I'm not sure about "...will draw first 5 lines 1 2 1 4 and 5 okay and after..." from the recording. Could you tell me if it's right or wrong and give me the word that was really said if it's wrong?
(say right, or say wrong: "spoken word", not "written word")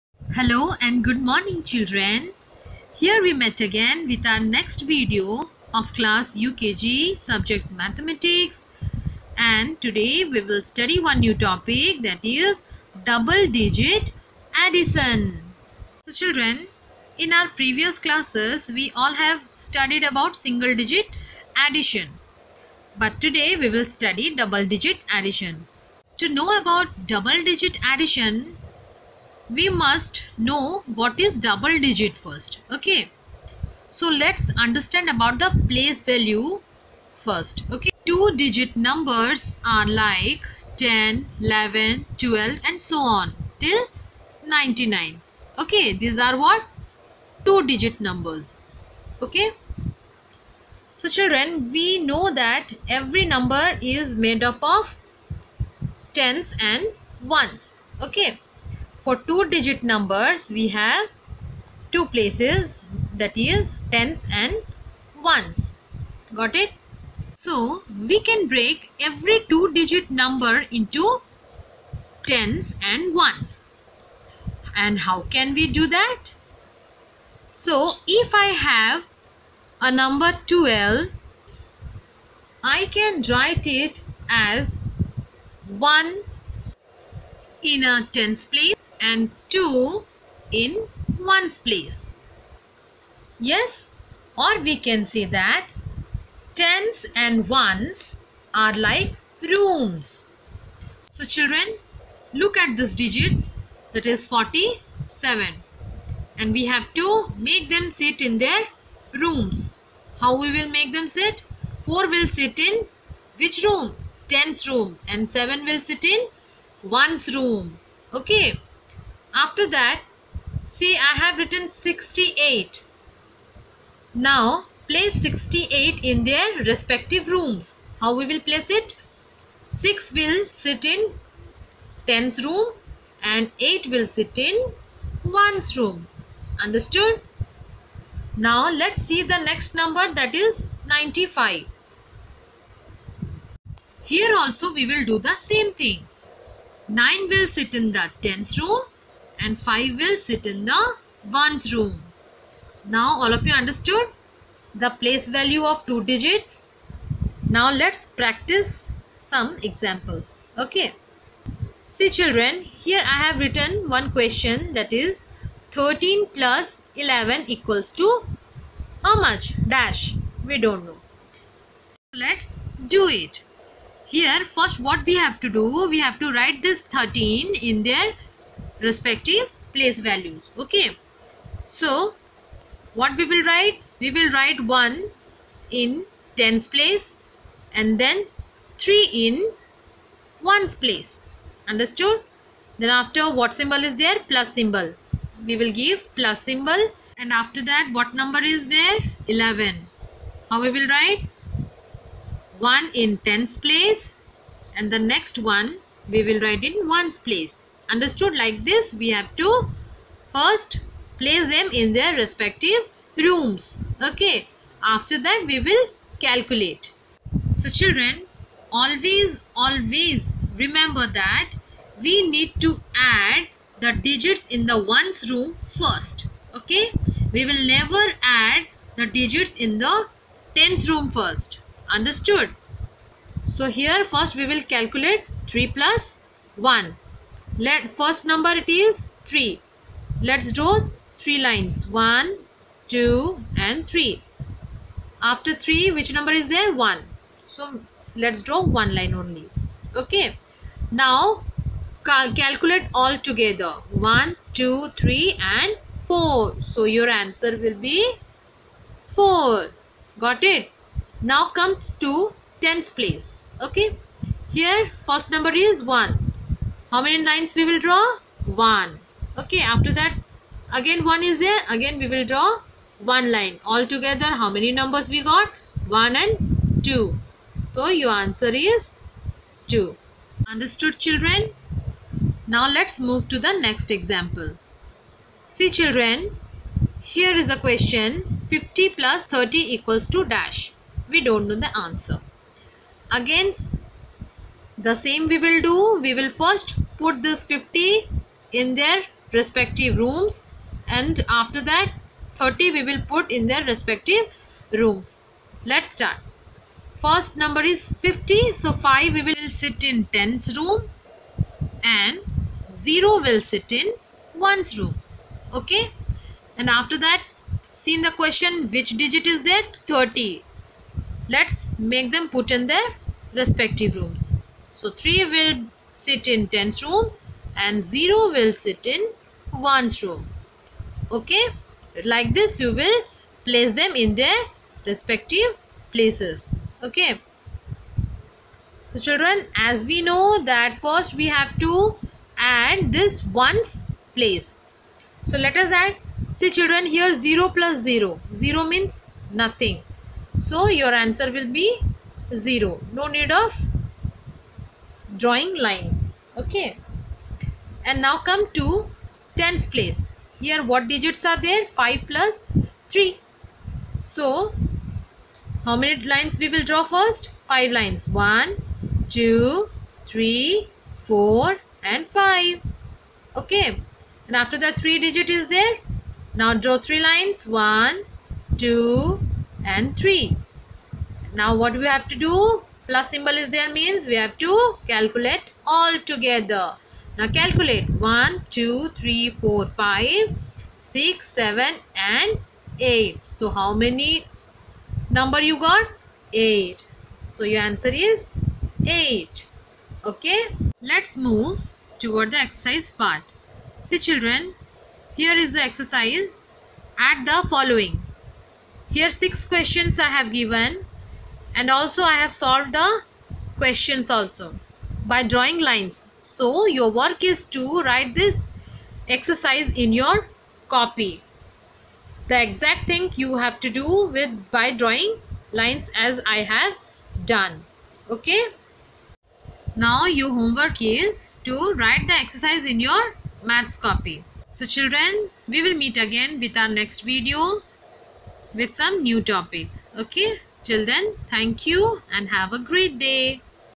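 wrong: "3", not "1".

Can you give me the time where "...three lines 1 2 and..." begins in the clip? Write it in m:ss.
4:01.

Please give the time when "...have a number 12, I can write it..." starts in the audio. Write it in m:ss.
1:18.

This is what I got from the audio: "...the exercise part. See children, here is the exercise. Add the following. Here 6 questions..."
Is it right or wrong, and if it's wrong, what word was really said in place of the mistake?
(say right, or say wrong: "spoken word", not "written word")
right.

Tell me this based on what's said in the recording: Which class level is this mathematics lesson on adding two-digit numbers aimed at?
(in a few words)
UKG.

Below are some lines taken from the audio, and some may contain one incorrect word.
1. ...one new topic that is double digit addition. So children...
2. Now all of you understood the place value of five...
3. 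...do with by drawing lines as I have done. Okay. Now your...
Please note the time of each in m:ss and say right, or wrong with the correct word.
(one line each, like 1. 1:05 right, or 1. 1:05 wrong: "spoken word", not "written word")
1. 0:11 right
2. 2:32 wrong: "two", not "five"
3. 7:03 right.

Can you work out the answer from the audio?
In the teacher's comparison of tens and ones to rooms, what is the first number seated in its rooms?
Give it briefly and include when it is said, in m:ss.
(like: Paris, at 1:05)
47, at 1:44.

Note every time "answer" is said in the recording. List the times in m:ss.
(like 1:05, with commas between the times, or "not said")
4:17, 4:38, 4:51, 5:50, 6:37.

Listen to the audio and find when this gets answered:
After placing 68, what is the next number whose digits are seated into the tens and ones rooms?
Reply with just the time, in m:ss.
2:20.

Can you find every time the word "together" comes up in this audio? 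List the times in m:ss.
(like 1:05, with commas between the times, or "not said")
4:13, 4:33, 6:26.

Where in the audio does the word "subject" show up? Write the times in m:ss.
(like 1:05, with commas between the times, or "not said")
0:07.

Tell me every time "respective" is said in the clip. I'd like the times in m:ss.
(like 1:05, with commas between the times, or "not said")
2:06, 2:58, 3:32, 4:59, 5:03, 5:23, 5:34.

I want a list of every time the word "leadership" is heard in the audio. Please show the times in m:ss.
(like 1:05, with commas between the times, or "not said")
not said.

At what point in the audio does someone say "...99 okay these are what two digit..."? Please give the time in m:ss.
0:44.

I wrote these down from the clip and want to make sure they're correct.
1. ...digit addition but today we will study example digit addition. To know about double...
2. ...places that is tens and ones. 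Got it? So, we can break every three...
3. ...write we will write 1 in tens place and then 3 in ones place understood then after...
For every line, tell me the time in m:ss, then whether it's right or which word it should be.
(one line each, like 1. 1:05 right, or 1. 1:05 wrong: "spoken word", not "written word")
1. 0:20 wrong: "double", not "example"
2. 1:02 wrong: "two", not "three"
3. 3:03 right.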